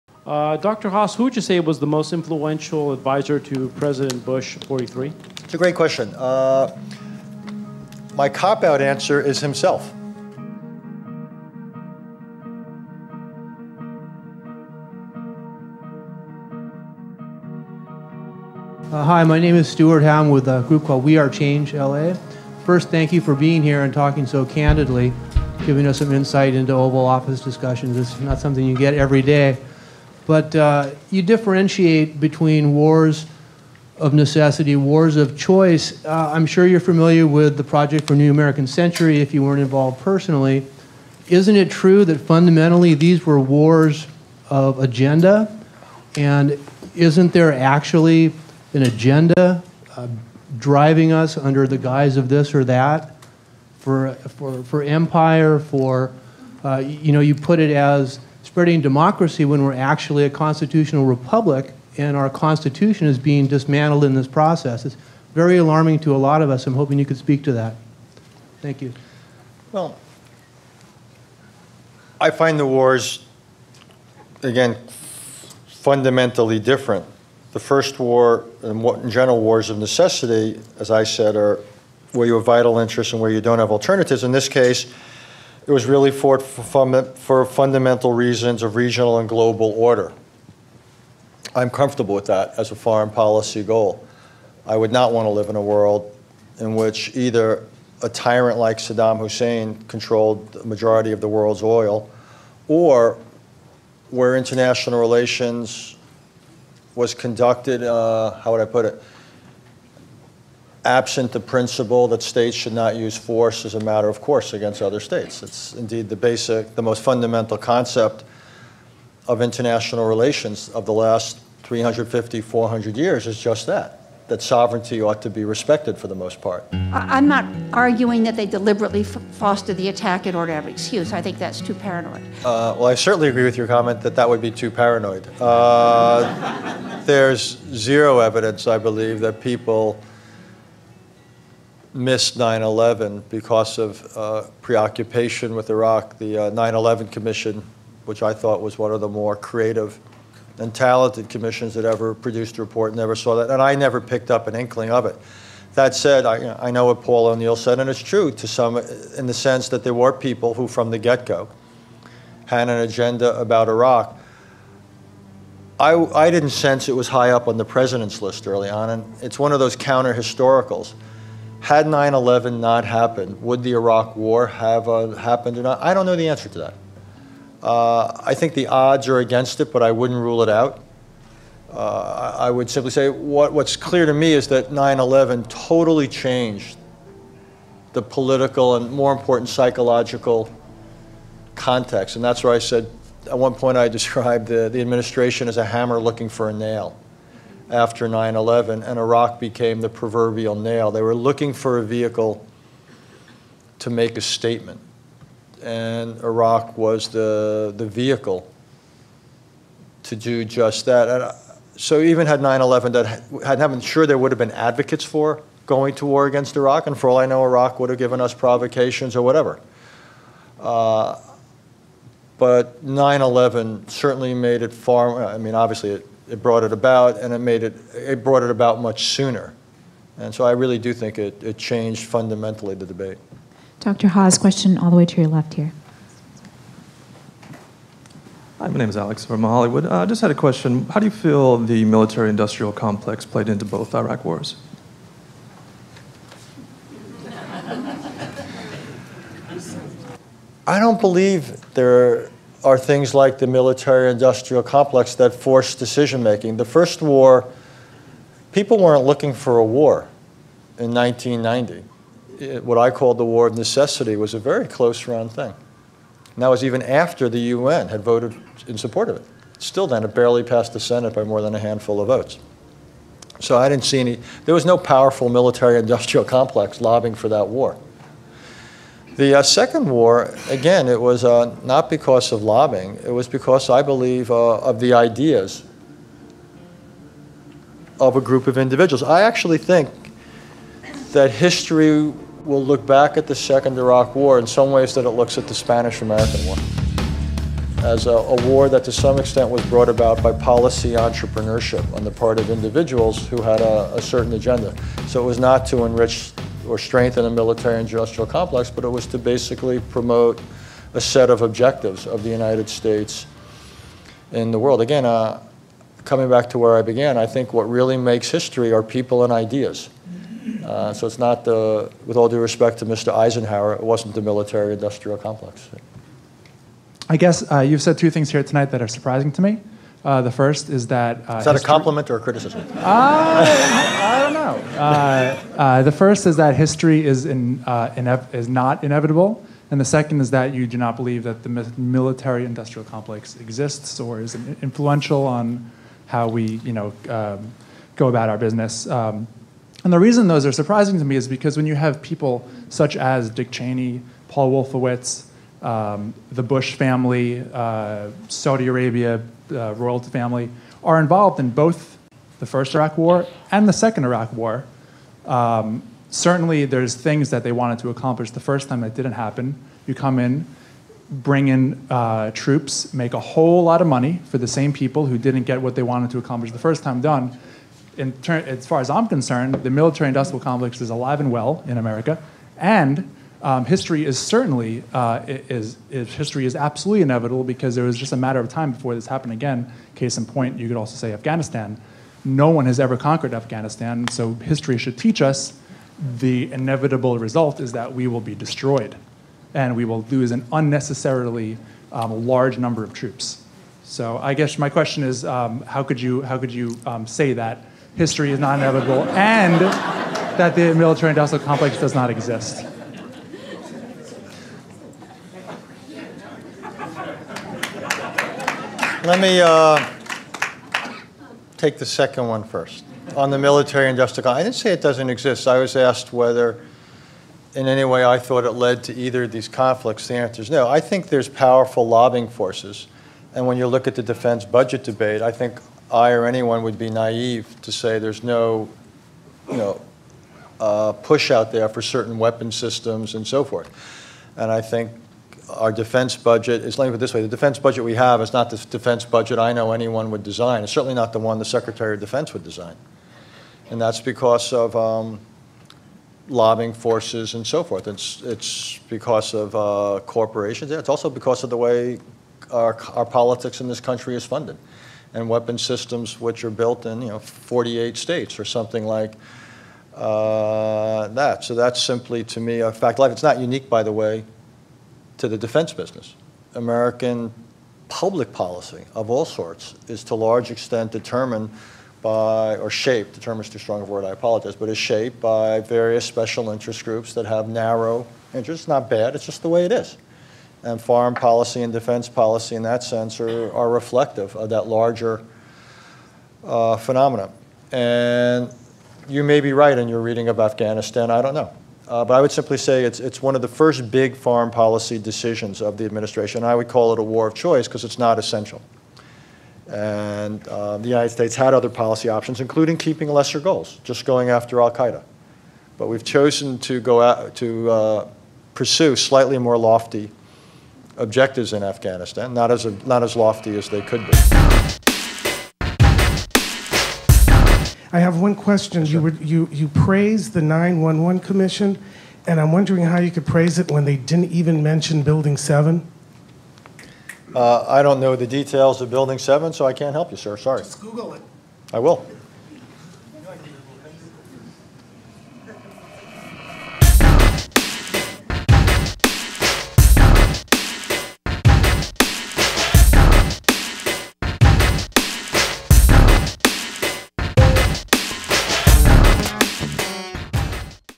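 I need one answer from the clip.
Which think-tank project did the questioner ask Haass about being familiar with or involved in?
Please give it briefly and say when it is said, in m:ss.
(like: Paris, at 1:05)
Project for New American Century, at 0:37.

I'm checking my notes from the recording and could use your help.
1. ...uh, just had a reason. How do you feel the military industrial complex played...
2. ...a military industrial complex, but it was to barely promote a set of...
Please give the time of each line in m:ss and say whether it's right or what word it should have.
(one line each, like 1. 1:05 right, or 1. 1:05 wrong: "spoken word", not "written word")
1. 4:00 wrong: "question", not "reason"
2. 5:07 wrong: "basically", not "barely".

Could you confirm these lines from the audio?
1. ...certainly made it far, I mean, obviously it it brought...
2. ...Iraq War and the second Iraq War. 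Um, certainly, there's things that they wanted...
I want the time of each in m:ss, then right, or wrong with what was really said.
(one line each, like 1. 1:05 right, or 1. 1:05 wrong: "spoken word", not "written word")
1. 3:43 right
2. 6:02 right.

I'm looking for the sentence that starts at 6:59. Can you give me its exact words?
Let me uh, take the second one first.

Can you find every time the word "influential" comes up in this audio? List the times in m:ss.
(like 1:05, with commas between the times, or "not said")
0:02, 5:44.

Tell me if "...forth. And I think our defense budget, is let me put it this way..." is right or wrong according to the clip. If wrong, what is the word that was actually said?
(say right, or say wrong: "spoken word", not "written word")
right.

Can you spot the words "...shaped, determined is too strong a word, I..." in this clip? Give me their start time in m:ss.
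8:02.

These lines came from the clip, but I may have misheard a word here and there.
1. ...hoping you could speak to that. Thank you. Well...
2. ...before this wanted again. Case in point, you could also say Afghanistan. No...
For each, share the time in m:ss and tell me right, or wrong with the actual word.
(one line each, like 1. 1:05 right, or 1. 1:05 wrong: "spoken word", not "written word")
1. 1:06 right
2. 6:28 wrong: "happened", not "wanted".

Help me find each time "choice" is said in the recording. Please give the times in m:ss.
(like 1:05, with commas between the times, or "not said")
0:35, 8:27.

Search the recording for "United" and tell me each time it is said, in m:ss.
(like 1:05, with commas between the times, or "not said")
5:12, 8:30.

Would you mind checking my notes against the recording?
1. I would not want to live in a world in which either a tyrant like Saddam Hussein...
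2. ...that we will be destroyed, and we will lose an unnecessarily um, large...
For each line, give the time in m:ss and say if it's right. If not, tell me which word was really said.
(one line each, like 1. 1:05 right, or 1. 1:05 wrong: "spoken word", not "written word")
1. 1:34 right
2. 6:37 right.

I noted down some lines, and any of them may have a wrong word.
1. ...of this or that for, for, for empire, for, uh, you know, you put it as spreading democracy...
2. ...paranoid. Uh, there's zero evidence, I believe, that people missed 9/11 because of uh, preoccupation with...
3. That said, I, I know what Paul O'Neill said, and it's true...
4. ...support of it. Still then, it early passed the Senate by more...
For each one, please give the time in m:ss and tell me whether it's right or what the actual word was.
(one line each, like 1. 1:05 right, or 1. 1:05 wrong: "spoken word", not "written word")
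1. 0:52 right
2. 2:14 right
3. 2:35 right
4. 4:28 wrong: "barely", not "early".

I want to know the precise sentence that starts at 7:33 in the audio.
And that's because of um, lobbying forces and so forth.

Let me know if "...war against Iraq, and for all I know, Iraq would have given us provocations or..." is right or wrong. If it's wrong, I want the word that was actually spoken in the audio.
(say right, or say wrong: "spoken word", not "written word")
right.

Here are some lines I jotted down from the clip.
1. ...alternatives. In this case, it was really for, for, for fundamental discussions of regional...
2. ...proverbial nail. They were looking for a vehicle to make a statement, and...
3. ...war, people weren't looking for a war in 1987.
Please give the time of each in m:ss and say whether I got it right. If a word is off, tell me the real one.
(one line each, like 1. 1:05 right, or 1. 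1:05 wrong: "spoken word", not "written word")
1. 1:23 wrong: "reasons", not "discussions"
2. 3:19 right
3. 4:17 wrong: "1990", not "1987".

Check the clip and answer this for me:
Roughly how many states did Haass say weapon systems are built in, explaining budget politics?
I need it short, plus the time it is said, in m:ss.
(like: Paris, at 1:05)
48, at 7:47.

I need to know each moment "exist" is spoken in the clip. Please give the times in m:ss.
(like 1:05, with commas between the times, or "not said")
5:43, 6:52, 7:05.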